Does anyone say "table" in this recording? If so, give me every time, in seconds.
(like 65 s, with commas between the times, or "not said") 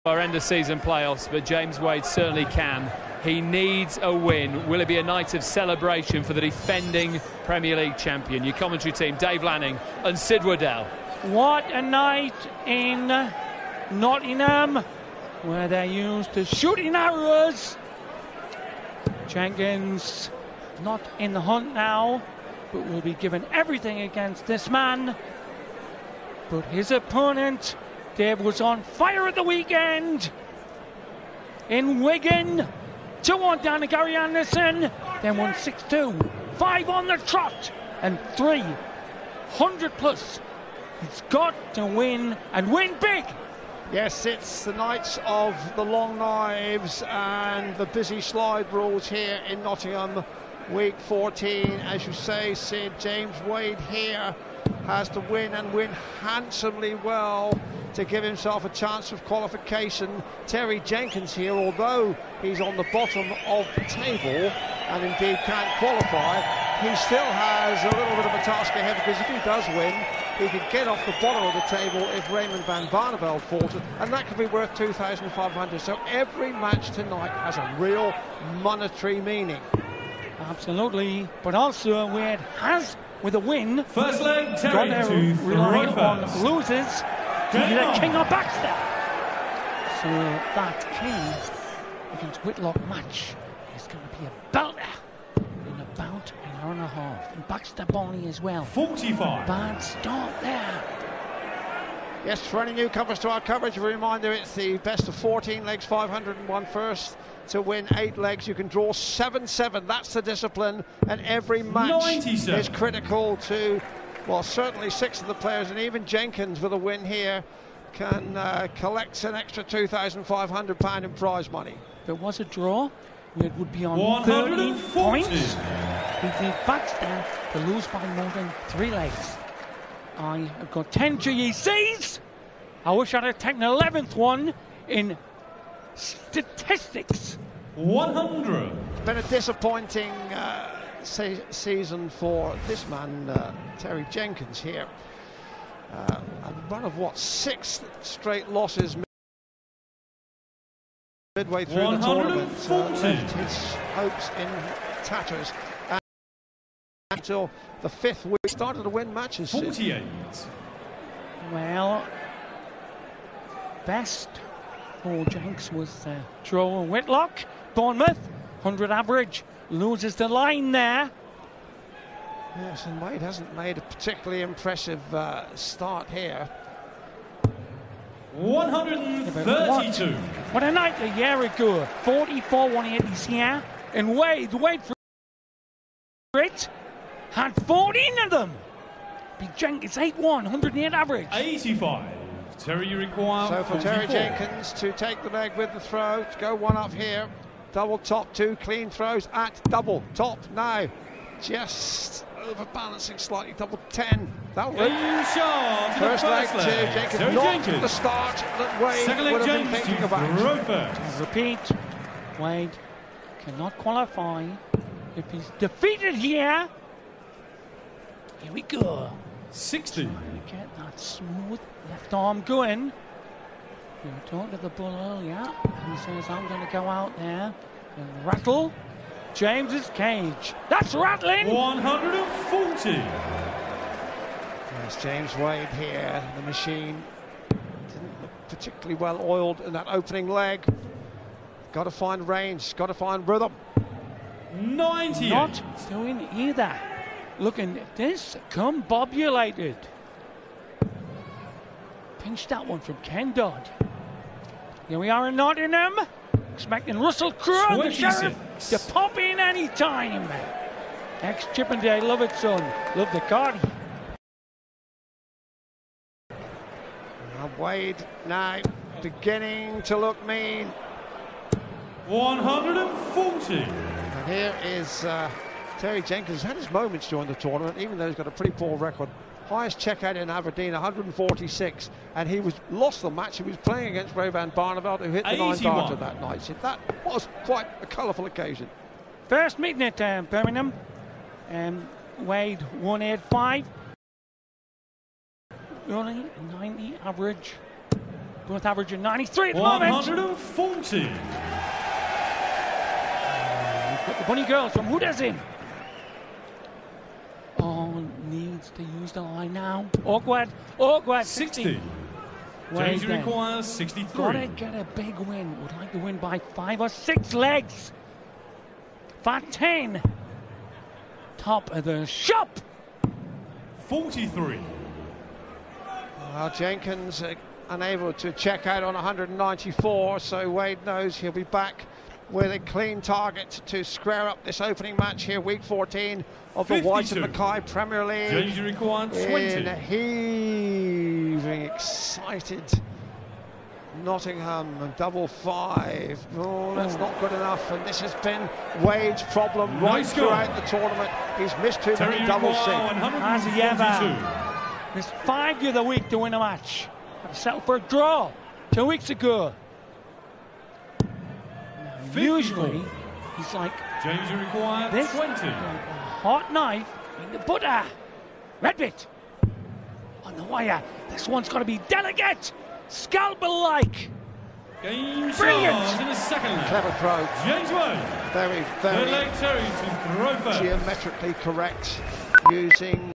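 63 s, 71 s.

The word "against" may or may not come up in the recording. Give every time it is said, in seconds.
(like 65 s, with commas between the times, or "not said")
24 s, 92 s, 283 s.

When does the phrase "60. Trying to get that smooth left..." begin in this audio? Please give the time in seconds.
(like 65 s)
219 s.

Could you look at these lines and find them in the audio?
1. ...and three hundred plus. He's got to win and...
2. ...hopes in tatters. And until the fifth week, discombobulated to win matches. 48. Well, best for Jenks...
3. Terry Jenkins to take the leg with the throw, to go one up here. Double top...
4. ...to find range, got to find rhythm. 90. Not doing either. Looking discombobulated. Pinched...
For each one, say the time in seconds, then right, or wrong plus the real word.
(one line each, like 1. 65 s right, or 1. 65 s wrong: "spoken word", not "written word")
1. 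38 s right
2. 153 s wrong: "started", not "discombobulated"
3. 193 s right
4. 241 s right.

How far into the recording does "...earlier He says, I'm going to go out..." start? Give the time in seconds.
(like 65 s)
224 s.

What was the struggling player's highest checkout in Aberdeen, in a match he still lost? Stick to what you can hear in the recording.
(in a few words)
146.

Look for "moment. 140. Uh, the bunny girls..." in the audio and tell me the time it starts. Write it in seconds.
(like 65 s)
300 s.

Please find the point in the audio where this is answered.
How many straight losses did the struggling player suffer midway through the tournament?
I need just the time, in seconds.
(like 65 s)
147 s.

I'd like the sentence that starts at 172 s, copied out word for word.
Yes, and Wade hasn't made a particularly impressive uh, start here.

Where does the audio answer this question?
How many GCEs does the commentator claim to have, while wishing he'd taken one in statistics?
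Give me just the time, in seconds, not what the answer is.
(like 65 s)
130 s.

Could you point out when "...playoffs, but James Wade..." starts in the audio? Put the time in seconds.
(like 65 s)
0 s.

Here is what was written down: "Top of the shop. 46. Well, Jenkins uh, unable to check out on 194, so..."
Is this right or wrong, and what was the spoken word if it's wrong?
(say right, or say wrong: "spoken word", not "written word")
wrong: "43", not "46".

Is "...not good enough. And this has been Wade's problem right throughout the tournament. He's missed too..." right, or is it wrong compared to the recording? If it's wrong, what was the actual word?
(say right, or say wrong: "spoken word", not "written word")
right.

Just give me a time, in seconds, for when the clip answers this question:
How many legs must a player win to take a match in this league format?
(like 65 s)
107 s.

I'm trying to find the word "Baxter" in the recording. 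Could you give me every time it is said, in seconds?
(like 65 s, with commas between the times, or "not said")
88 s, 97 s.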